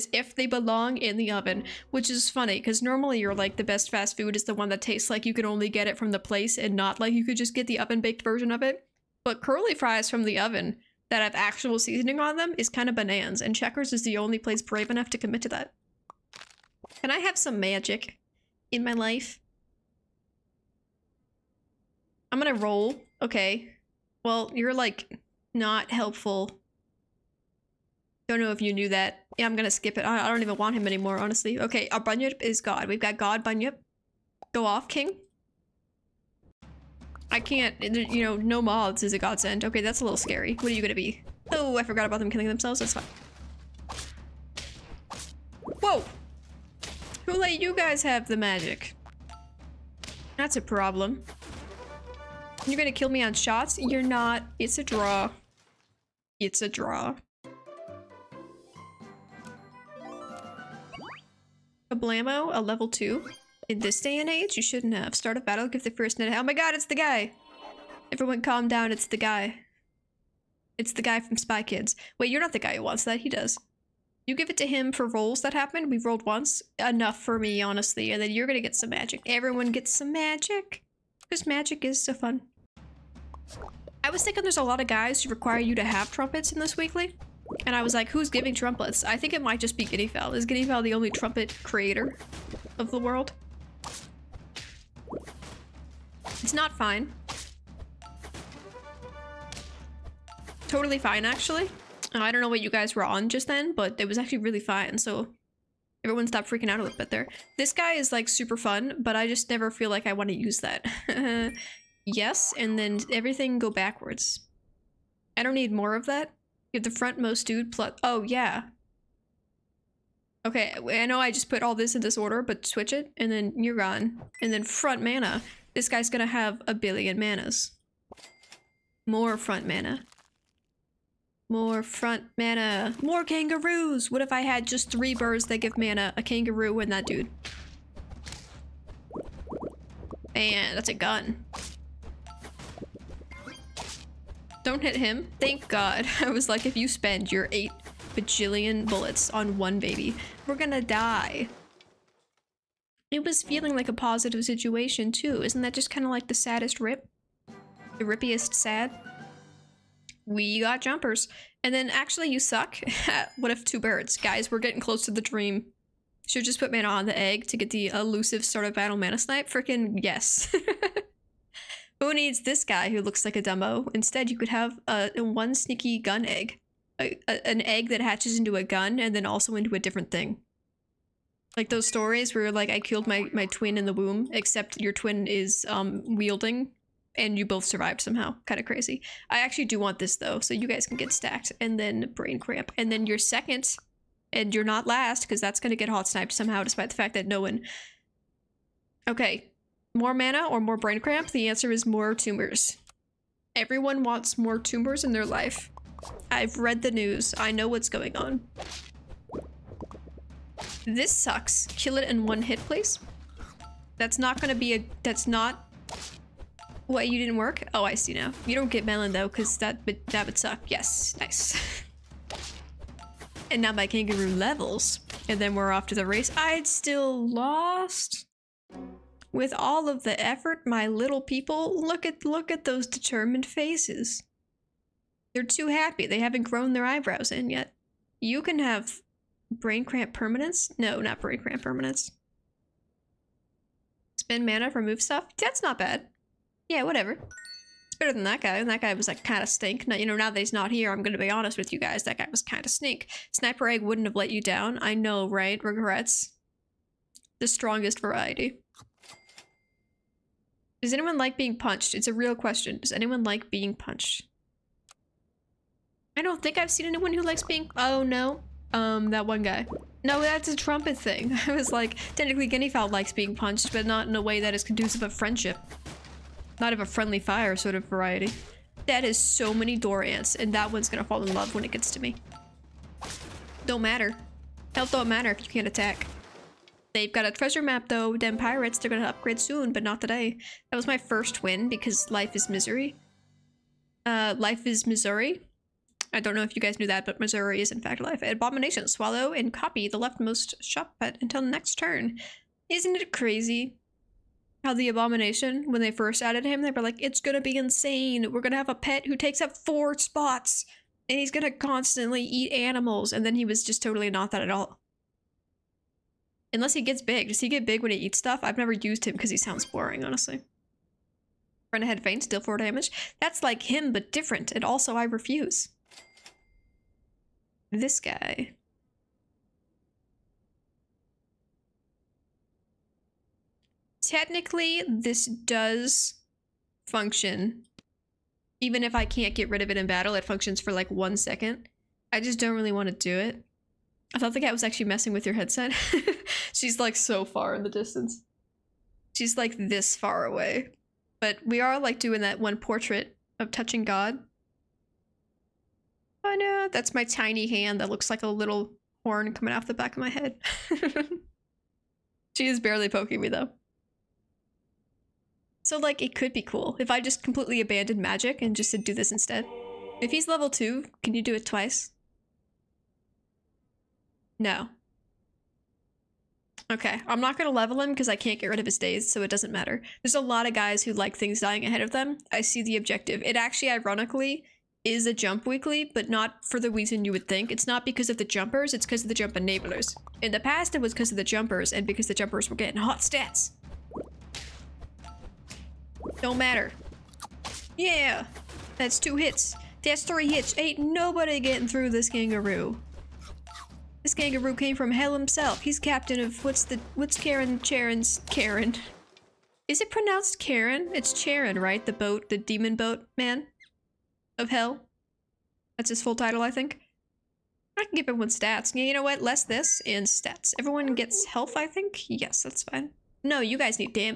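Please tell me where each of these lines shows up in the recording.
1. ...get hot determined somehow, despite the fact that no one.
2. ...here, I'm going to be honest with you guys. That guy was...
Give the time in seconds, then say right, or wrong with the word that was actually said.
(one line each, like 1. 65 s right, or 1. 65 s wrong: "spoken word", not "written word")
1. 195 s wrong: "sniped", not "determined"
2. 250 s right.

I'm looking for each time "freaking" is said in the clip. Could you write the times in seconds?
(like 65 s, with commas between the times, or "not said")
106 s, 169 s.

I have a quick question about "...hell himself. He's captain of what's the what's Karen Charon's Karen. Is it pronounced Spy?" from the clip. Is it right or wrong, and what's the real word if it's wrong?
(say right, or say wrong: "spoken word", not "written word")
wrong: "Karen", not "Spy".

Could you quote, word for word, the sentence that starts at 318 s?
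I've never used him because he sounds boring, honestly.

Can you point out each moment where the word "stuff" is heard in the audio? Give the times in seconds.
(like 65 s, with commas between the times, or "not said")
245 s, 318 s.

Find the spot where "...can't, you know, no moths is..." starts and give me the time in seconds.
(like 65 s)
37 s.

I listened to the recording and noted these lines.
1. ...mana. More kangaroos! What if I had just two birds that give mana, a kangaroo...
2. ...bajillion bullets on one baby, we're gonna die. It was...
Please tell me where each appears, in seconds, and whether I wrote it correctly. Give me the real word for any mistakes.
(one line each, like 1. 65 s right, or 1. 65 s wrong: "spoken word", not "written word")
1. 132 s wrong: "three", not "two"
2. 148 s right.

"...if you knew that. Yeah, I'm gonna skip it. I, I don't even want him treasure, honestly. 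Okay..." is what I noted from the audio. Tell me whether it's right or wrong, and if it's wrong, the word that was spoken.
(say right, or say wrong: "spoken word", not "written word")
wrong: "anymore", not "treasure".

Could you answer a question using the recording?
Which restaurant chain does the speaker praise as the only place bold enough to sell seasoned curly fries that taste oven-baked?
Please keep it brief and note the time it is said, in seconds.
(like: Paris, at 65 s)
Checkers, at 13 s.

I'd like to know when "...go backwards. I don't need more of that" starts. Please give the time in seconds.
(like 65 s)
113 s.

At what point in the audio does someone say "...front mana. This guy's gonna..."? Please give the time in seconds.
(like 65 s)
124 s.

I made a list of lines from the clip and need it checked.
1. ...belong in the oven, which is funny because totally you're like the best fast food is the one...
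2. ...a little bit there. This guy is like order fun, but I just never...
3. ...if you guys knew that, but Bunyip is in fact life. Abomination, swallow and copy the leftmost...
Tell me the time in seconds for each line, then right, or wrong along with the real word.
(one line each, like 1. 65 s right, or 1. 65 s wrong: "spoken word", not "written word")
1. 0 s wrong: "normally", not "totally"
2. 106 s wrong: "super", not "order"
3. 296 s wrong: "Missouri", not "Bunyip".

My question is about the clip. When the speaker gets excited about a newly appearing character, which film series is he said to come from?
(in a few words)
Spy Kids.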